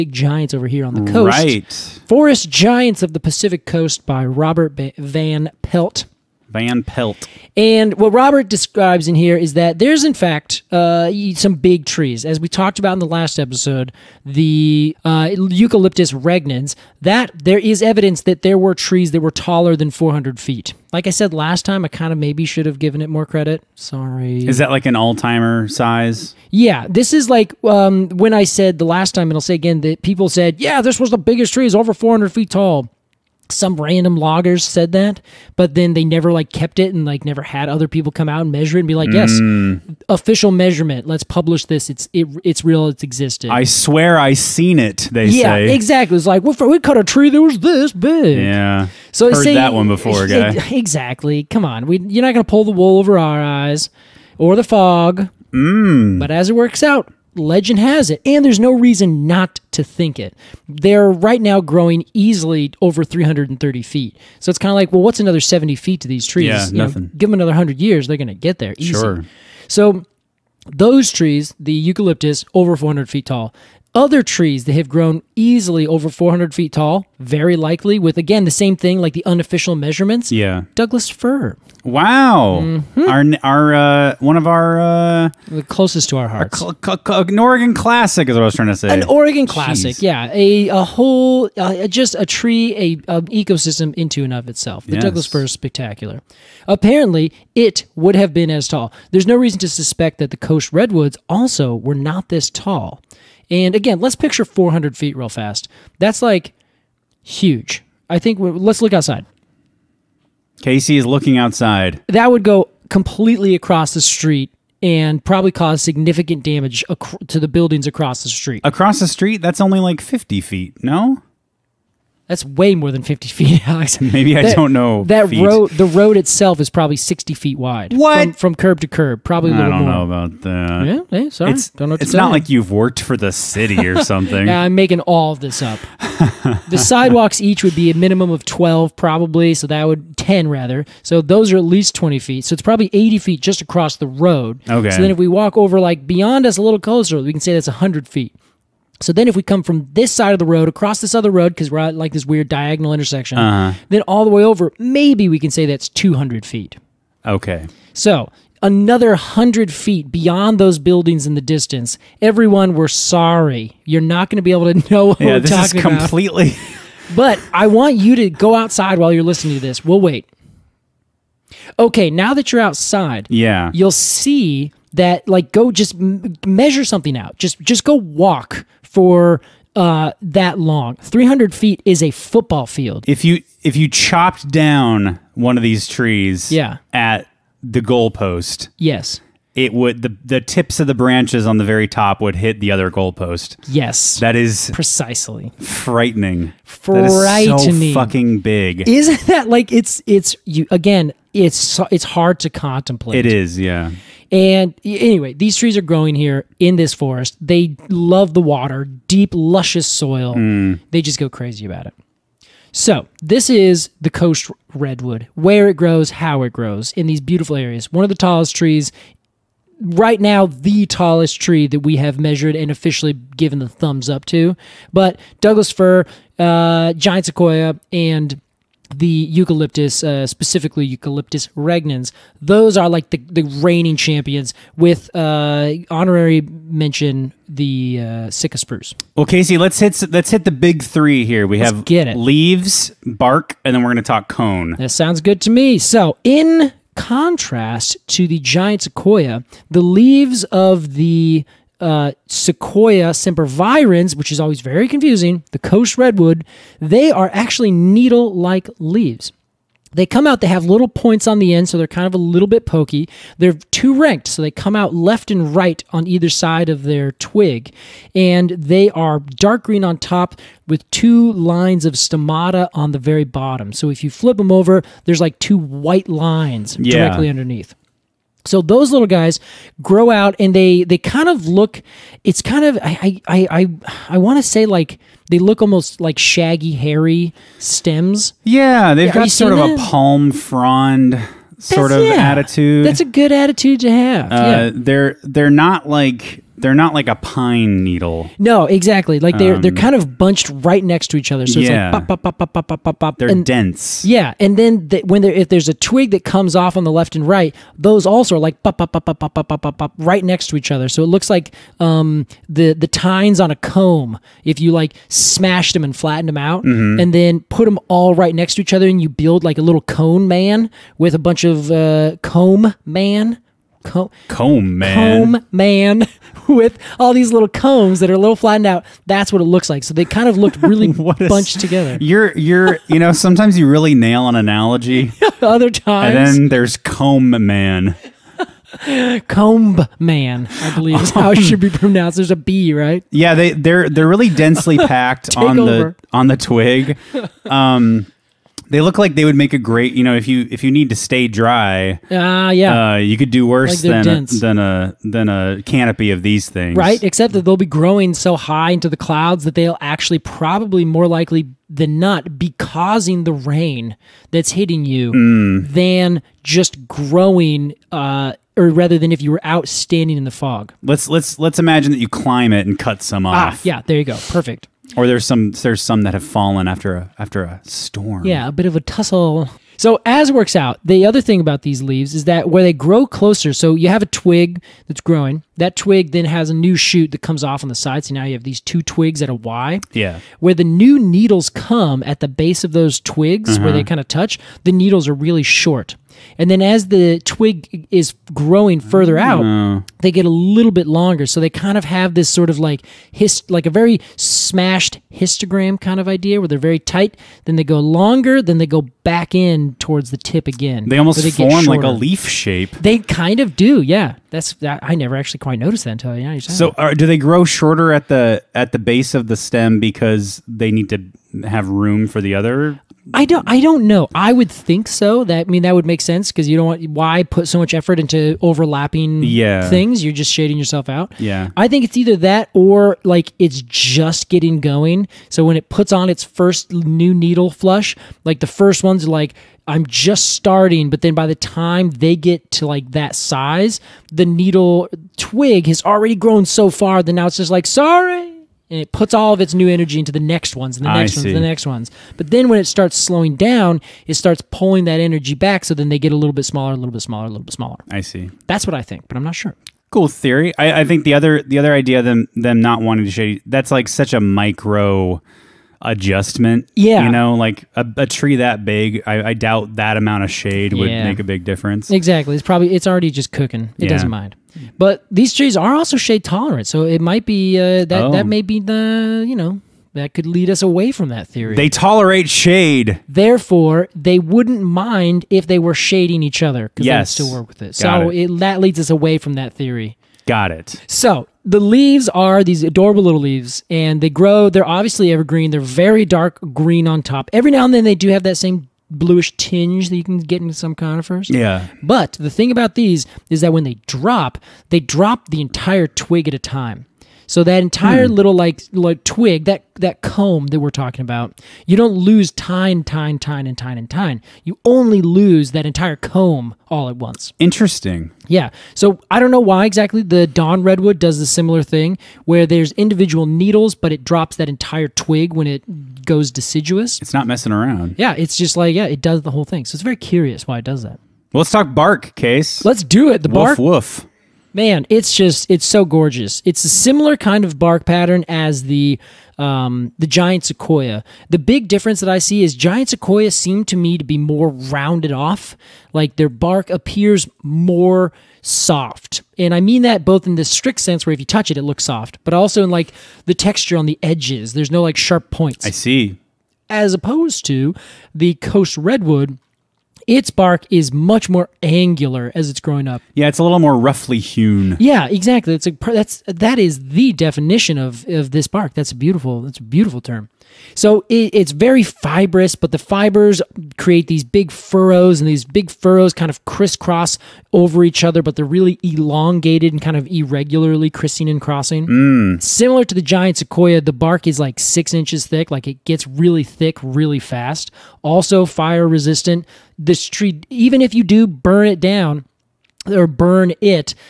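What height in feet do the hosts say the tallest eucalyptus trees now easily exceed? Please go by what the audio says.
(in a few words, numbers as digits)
330 feet.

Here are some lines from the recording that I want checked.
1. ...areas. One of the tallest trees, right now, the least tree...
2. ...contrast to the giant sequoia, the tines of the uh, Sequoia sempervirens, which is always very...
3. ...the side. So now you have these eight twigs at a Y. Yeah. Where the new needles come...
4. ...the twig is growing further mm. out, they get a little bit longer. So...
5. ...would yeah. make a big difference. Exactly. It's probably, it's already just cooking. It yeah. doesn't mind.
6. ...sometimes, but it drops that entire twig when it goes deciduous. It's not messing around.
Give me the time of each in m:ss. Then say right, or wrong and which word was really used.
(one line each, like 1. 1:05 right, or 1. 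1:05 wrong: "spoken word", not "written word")
1. 3:37 wrong: "tallest", not "least"
2. 4:06 wrong: "leaves", not "tines"
3. 6:27 wrong: "two", not "eight"
4. 6:36 right
5. 7:50 right
6. 8:43 wrong: "needles", not "sometimes".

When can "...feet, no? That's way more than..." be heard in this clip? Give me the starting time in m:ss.
2:00.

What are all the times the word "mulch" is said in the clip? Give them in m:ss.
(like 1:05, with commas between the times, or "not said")
not said.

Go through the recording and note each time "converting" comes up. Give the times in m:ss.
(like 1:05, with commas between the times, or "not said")
not said.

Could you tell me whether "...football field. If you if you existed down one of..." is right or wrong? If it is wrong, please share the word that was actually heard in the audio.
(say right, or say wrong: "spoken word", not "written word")
wrong: "chopped", not "existed".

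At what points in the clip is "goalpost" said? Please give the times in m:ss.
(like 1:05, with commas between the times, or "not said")
3:07, 3:12.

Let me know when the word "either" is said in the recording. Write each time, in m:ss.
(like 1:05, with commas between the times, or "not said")
4:26, 7:11.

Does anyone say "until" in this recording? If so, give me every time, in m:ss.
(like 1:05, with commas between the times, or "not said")
6:56.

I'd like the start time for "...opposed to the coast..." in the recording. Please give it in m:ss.
9:16.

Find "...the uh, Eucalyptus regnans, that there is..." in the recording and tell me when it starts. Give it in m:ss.
0:14.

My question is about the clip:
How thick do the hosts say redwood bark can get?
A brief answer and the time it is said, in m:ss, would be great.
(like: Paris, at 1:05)
6 inches, at 9:44.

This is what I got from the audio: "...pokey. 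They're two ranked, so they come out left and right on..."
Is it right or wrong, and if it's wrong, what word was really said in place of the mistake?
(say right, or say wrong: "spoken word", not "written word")
right.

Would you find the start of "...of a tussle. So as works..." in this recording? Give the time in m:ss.
6:18.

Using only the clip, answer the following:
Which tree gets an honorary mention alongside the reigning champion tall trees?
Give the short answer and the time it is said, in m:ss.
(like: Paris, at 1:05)
Sitka spruce, at 3:58.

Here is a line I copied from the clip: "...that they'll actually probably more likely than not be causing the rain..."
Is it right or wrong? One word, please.
right.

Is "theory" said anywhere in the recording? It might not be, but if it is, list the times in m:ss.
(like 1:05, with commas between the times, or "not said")
7:40, 8:01, 8:09.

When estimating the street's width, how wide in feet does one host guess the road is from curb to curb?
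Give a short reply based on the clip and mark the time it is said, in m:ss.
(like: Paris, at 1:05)
60 feet, at 2:06.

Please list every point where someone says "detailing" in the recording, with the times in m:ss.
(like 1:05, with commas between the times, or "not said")
not said.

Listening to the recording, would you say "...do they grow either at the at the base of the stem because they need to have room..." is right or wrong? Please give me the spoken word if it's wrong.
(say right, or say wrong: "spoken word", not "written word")
wrong: "shorter", not "either".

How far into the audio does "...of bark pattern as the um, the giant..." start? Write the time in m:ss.
8:57.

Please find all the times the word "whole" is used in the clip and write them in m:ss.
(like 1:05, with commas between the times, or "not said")
1:30, 8:49.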